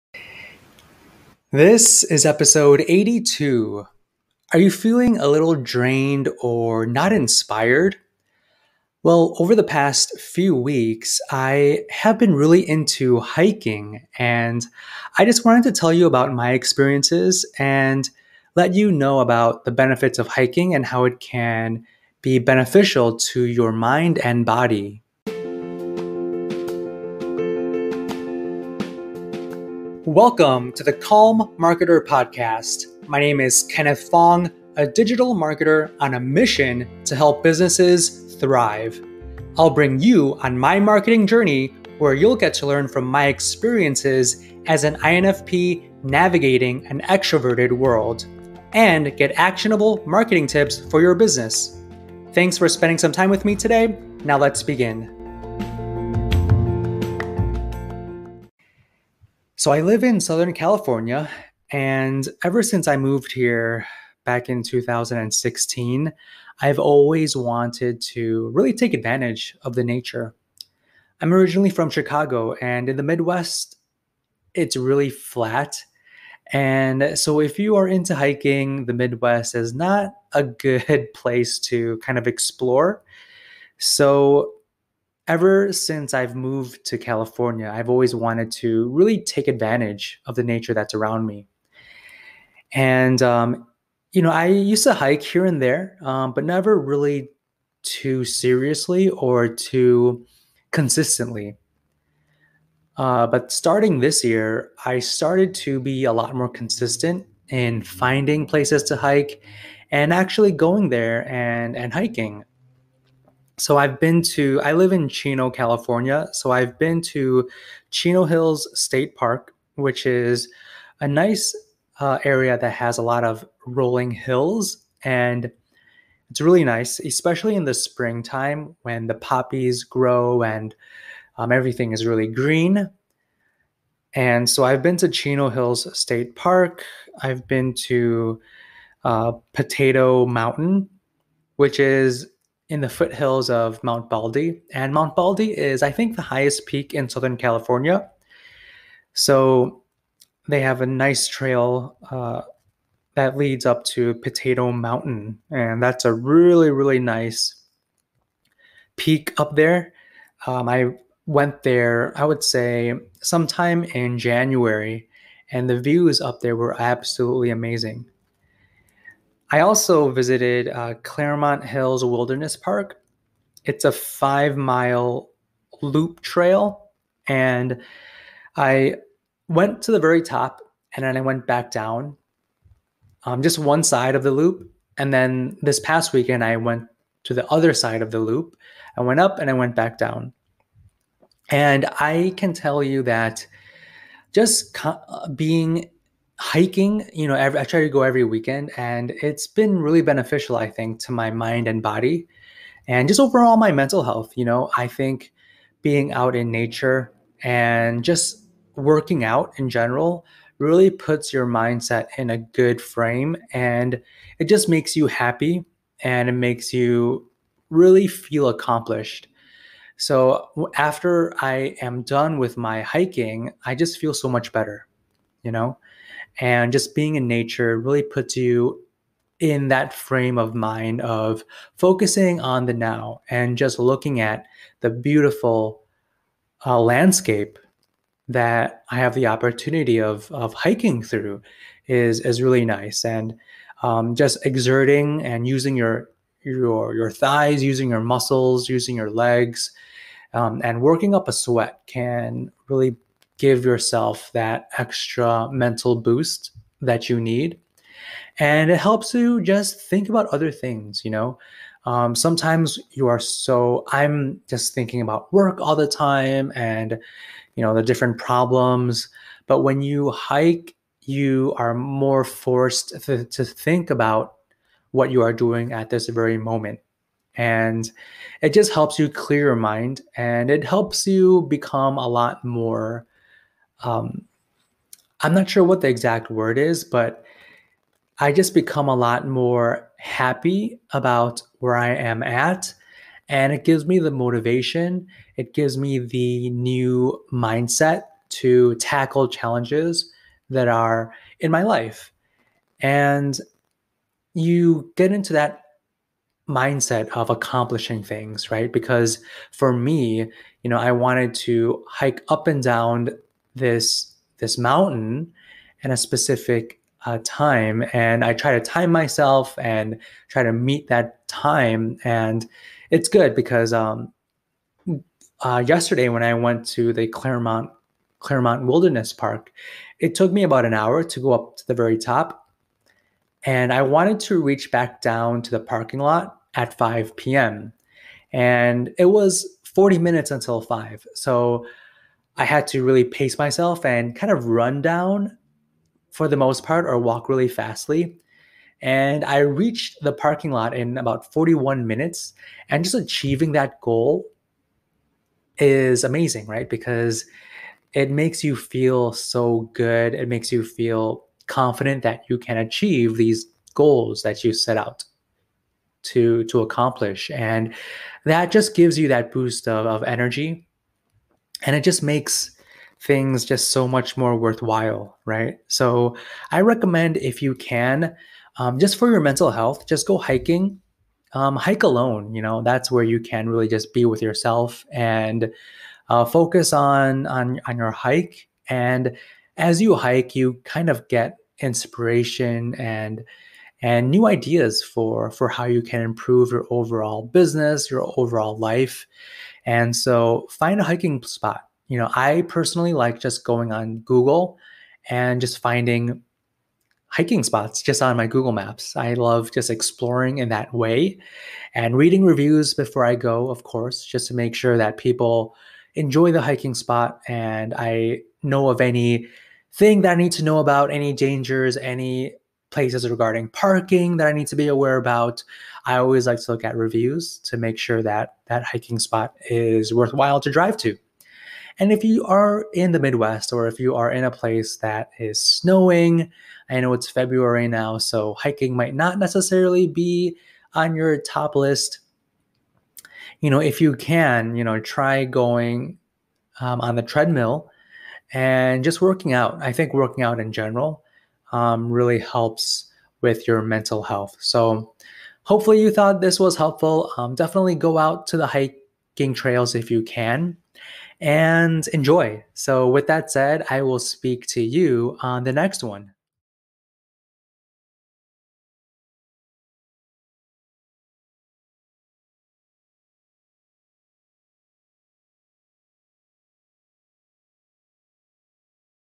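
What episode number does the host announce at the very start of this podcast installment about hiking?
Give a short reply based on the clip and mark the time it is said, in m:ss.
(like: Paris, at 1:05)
82, at 0:02.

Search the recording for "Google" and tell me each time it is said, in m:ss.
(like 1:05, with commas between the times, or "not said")
6:43, 6:48.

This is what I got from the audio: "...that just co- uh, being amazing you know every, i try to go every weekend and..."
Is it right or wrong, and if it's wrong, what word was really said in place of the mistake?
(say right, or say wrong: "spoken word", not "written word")
wrong: "hiking", not "amazing".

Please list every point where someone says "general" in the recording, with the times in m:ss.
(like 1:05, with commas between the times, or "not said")
3:29, 7:30.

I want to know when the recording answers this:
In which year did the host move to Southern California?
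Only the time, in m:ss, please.
1:04.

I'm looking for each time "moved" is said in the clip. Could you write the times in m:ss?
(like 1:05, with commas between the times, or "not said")
1:02, 1:26.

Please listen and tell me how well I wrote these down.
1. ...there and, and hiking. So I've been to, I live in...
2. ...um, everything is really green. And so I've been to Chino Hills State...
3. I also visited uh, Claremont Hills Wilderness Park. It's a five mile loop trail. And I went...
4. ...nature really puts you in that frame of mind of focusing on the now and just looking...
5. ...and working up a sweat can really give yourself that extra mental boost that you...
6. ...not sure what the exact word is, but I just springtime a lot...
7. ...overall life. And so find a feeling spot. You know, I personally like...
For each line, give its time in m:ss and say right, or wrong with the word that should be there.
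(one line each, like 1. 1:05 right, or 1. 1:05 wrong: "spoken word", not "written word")
1. 1:50 right
2. 2:11 right
3. 2:49 right
4. 3:47 right
5. 4:10 right
6. 4:45 wrong: "become", not "springtime"
7. 6:38 wrong: "hiking", not "feeling".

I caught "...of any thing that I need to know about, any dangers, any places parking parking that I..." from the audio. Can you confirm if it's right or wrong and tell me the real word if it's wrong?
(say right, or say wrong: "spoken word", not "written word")
wrong: "regarding", not "parking".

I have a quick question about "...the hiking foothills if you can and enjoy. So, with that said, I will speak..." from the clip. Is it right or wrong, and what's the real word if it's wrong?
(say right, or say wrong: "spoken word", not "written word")
wrong: "trails", not "foothills".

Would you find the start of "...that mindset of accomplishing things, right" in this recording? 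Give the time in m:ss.
5:05.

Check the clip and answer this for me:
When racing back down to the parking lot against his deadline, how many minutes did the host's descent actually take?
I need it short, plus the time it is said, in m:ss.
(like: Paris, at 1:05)
41 minutes, at 5:51.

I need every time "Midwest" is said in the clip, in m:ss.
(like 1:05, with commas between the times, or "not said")
1:13, 1:18, 7:12.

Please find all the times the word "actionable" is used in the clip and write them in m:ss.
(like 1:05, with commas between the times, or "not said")
0:49.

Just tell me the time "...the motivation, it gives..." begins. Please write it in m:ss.
4:53.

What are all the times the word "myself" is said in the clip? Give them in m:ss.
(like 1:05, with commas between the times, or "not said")
5:18, 5:43.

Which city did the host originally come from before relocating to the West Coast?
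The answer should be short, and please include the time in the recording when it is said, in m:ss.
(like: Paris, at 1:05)
Chicago, at 1:11.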